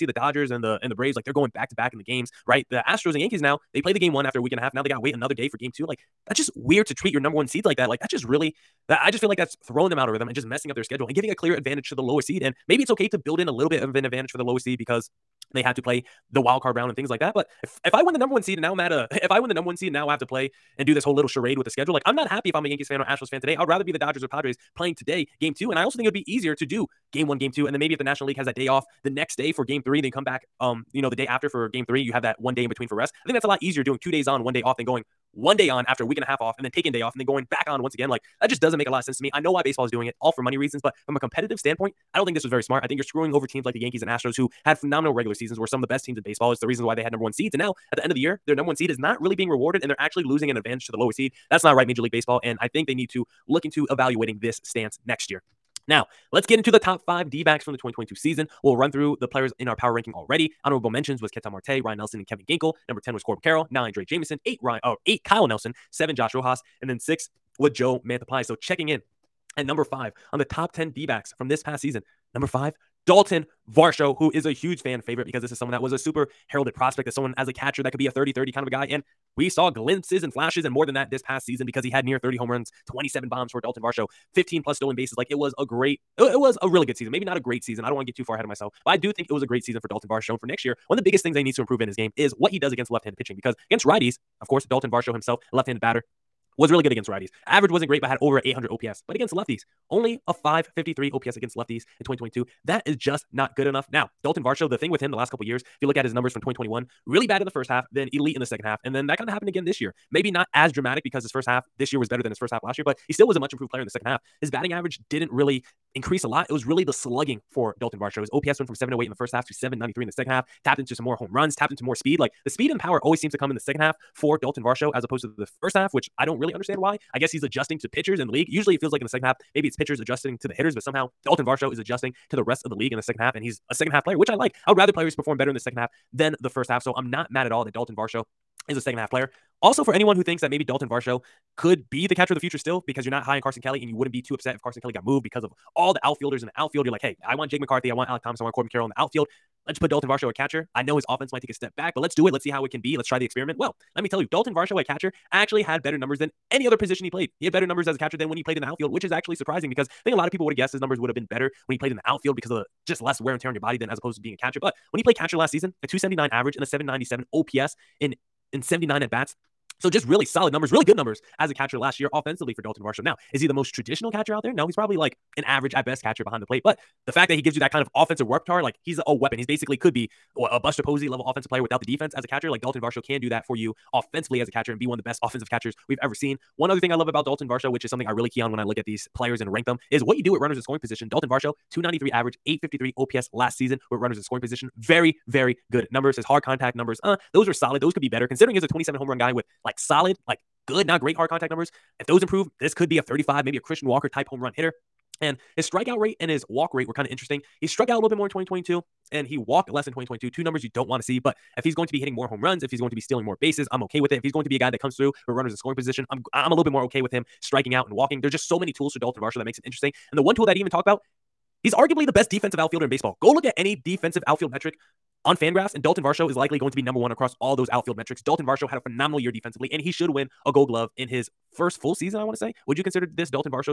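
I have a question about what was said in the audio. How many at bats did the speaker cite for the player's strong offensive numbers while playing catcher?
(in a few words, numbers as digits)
79.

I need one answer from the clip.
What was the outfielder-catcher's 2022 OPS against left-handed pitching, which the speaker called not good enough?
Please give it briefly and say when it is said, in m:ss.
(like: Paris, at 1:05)
553, at 1:40.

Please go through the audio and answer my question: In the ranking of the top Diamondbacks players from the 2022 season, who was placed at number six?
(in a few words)
Joe Mantiply.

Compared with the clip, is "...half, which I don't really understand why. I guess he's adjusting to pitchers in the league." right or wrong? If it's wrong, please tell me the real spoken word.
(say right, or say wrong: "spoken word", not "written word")
right.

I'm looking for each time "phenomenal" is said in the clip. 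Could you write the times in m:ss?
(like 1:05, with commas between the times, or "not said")
0:44, 3:48.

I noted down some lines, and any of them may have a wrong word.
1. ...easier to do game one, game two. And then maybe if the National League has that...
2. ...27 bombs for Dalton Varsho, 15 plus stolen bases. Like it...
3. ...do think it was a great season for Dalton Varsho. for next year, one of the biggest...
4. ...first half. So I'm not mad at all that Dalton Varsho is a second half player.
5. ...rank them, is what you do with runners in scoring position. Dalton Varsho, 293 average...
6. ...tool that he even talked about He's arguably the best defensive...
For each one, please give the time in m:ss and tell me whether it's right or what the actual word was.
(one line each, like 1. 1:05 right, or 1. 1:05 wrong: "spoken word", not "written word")
1. 0:26 right
2. 1:22 right
3. 1:28 right
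4. 2:16 right
5. 3:09 right
6. 3:40 right.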